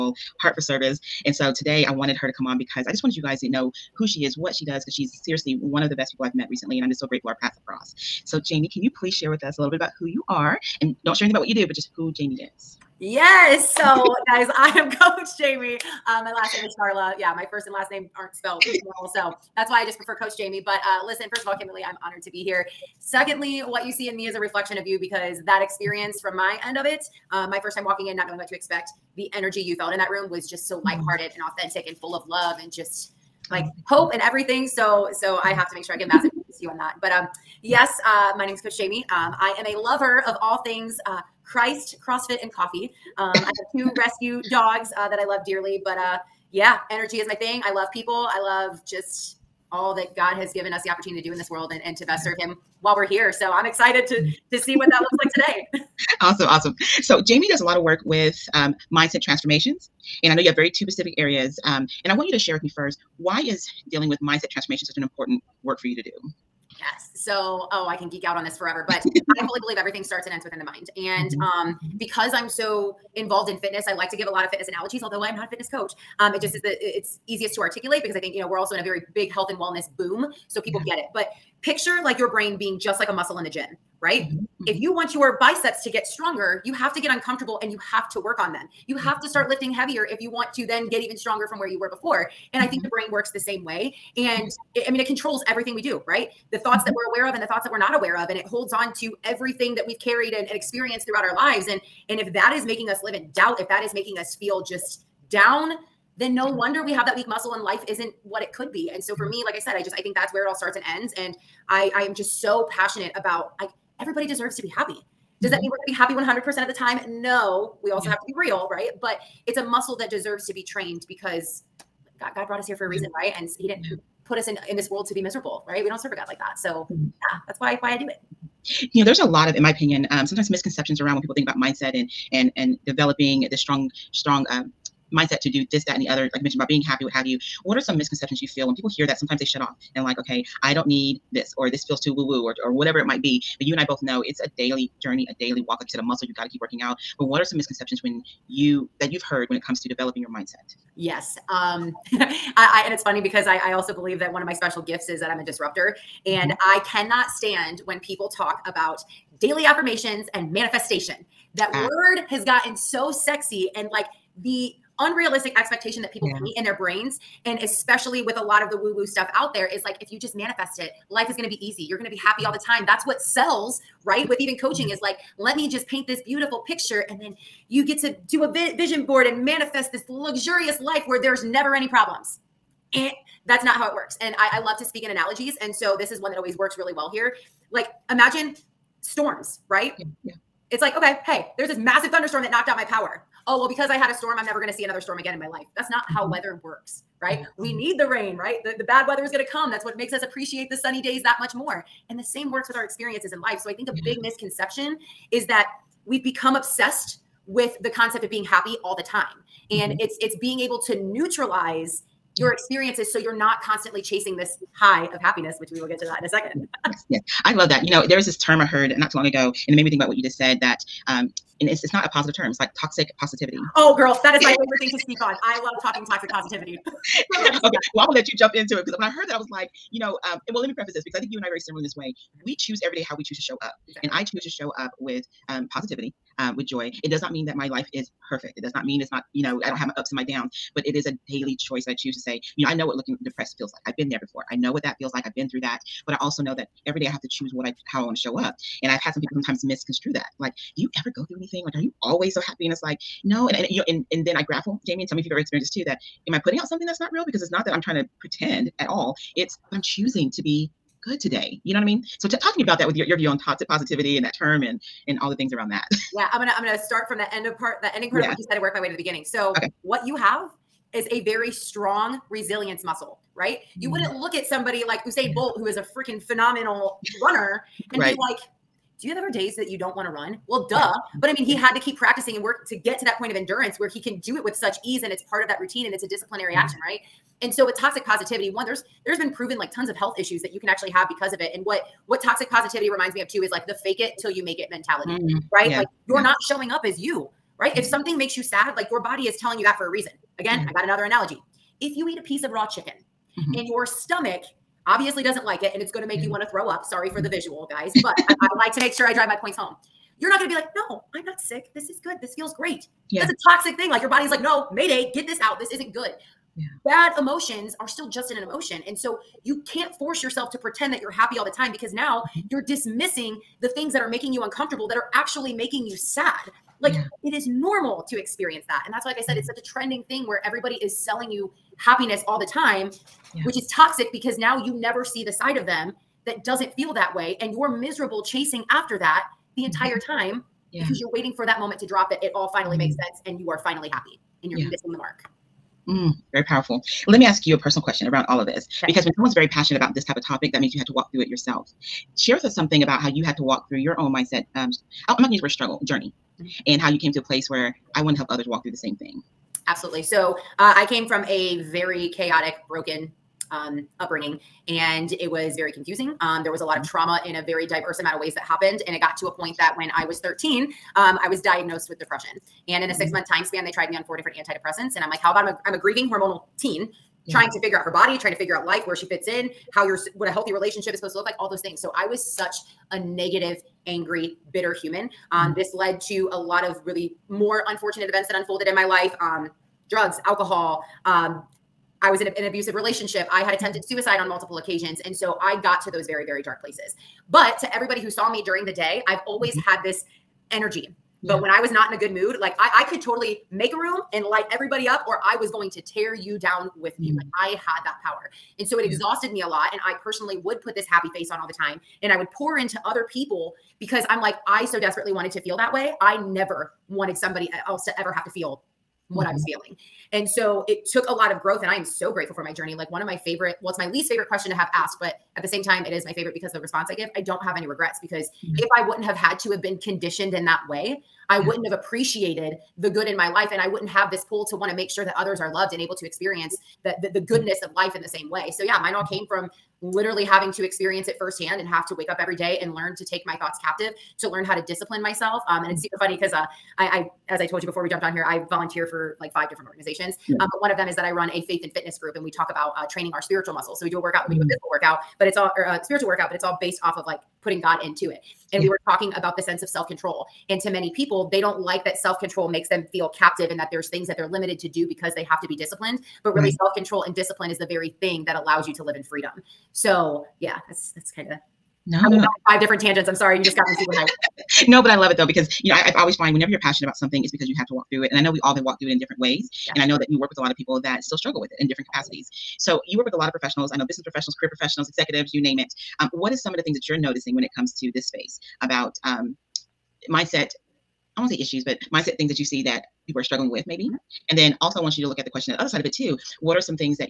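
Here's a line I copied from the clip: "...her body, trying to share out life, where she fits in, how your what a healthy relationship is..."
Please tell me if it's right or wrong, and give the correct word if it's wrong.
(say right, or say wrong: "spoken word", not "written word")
wrong: "figure", not "share".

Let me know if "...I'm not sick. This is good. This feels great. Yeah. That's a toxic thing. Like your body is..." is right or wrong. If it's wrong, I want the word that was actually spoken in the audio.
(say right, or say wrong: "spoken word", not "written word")
right.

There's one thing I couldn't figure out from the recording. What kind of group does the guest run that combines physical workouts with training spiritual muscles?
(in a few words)
faith and fitness group.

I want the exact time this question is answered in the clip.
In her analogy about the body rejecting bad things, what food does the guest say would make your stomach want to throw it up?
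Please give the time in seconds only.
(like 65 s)
302 s.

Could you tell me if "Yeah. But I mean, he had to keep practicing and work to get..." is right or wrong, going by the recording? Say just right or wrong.
right.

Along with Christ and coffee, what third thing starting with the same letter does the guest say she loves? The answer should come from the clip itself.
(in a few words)
CrossFit.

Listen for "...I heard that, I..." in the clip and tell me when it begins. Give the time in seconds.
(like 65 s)
229 s.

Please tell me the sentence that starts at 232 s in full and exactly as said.
We choose every day how we choose to show up, exactly.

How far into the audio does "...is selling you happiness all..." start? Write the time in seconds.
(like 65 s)
330 s.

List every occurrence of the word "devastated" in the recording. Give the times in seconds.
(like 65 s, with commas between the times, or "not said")
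not said.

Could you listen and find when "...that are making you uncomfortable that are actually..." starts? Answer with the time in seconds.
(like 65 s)
323 s.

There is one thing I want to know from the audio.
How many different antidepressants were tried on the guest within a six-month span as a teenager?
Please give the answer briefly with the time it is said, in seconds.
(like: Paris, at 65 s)
4, at 374 s.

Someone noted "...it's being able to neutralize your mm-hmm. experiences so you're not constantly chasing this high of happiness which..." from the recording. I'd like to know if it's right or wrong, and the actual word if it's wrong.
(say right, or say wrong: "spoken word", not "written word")
right.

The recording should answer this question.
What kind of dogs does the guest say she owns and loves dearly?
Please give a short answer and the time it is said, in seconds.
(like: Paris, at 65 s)
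rescue dogs, at 43 s.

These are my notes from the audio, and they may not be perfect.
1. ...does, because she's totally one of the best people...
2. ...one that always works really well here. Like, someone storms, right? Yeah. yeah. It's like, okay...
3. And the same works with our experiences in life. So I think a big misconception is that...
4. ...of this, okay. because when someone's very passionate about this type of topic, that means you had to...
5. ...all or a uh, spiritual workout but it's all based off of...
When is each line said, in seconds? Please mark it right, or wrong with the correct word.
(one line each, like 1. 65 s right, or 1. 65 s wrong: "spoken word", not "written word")
1. 4 s wrong: "seriously", not "totally"
2. 186 s wrong: "imagine", not "someone"
3. 202 s right
4. 348 s right
5. 455 s right.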